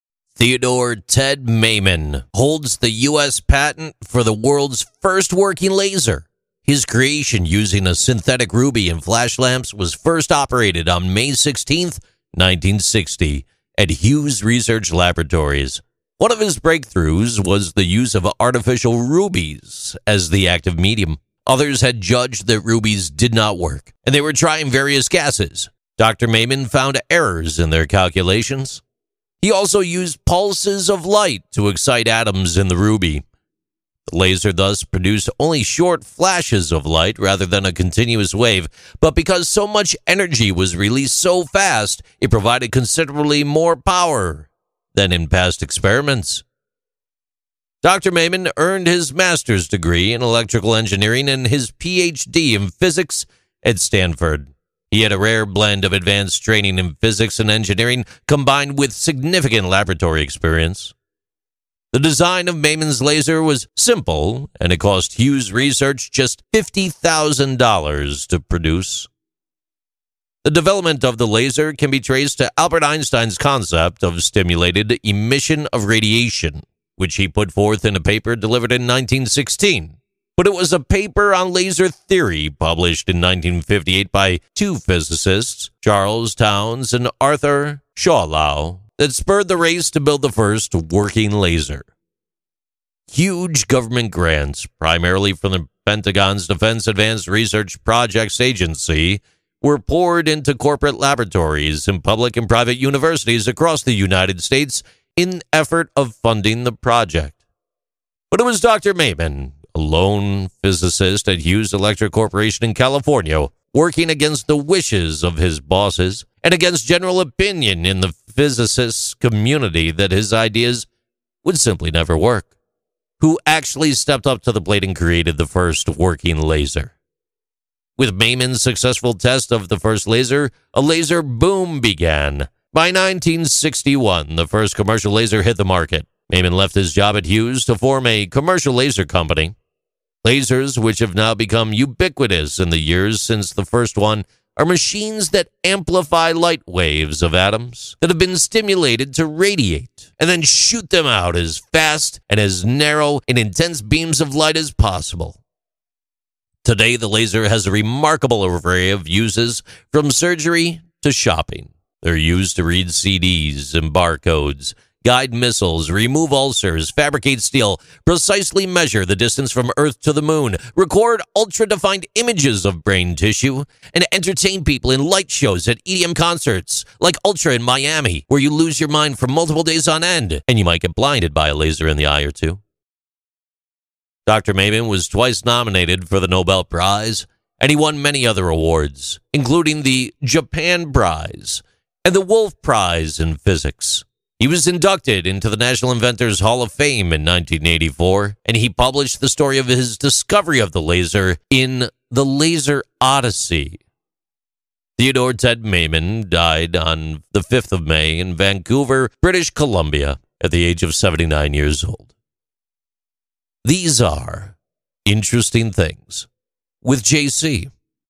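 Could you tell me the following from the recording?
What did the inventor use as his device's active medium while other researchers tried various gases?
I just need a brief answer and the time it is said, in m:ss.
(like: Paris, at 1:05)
Artificial rubies, at 0:18.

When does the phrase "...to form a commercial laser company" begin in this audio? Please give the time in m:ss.
2:17.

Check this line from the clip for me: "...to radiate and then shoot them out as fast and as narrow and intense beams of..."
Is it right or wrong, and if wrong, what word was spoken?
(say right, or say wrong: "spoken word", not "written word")
right.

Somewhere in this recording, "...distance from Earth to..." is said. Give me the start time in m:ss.
2:49.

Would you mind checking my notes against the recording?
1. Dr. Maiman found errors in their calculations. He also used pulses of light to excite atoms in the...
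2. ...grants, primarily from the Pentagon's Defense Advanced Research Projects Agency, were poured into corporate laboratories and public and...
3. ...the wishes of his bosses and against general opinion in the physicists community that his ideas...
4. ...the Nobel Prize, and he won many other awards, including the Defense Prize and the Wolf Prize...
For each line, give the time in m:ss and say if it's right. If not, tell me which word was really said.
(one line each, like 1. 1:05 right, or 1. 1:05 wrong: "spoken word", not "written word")
1. 0:25 right
2. 1:34 right
3. 1:54 right
4. 3:06 wrong: "Japan", not "Defense".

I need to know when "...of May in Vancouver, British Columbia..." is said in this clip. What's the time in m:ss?
3:27.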